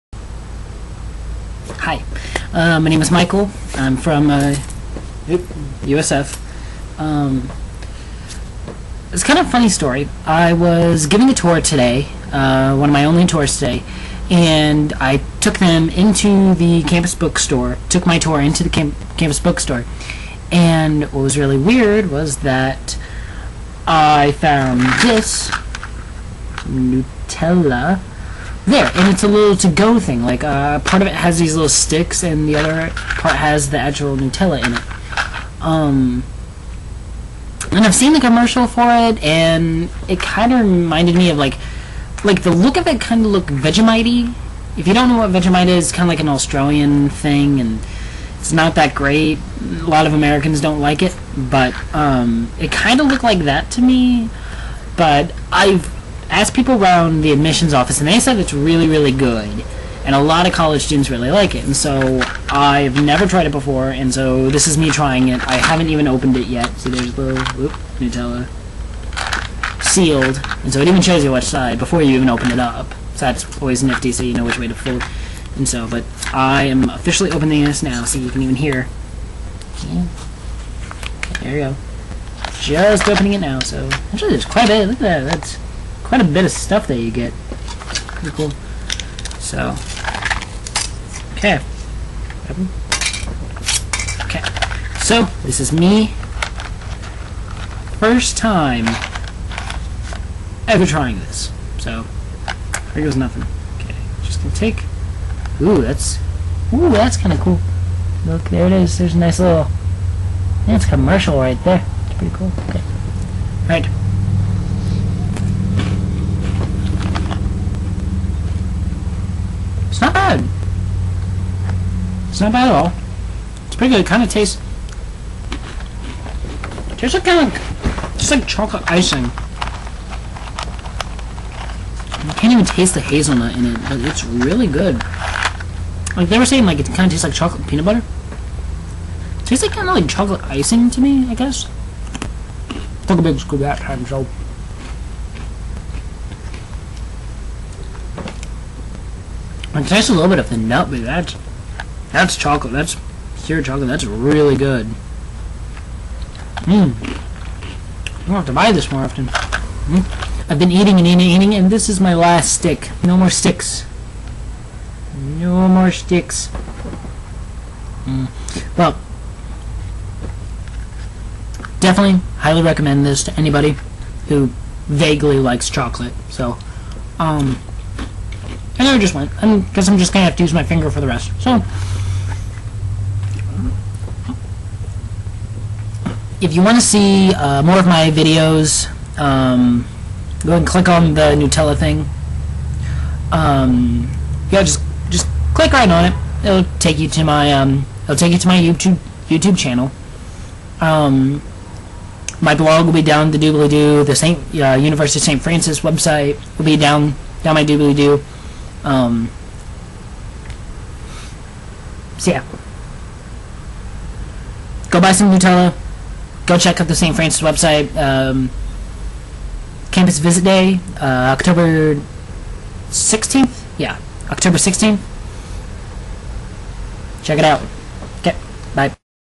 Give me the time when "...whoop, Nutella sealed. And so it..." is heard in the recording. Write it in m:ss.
1:07.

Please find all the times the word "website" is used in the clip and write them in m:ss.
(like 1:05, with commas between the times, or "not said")
3:25, 3:37.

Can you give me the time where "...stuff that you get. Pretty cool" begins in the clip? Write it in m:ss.
1:26.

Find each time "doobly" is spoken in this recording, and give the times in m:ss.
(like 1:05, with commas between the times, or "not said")
3:23, 3:27.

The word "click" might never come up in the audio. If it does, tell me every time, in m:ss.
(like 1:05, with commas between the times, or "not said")
3:10, 3:15.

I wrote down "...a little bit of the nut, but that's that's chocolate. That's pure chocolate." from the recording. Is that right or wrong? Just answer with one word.
right.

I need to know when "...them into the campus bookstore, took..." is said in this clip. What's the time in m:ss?
0:15.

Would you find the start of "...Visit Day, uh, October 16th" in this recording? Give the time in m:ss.
3:40.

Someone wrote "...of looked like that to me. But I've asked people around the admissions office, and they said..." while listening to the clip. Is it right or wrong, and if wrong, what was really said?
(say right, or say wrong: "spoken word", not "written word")
right.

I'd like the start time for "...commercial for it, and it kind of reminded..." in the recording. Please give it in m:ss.
0:38.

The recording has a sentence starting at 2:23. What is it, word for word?
Took a big scoop that time, so.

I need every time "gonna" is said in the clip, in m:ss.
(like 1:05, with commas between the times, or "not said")
1:44, 2:38.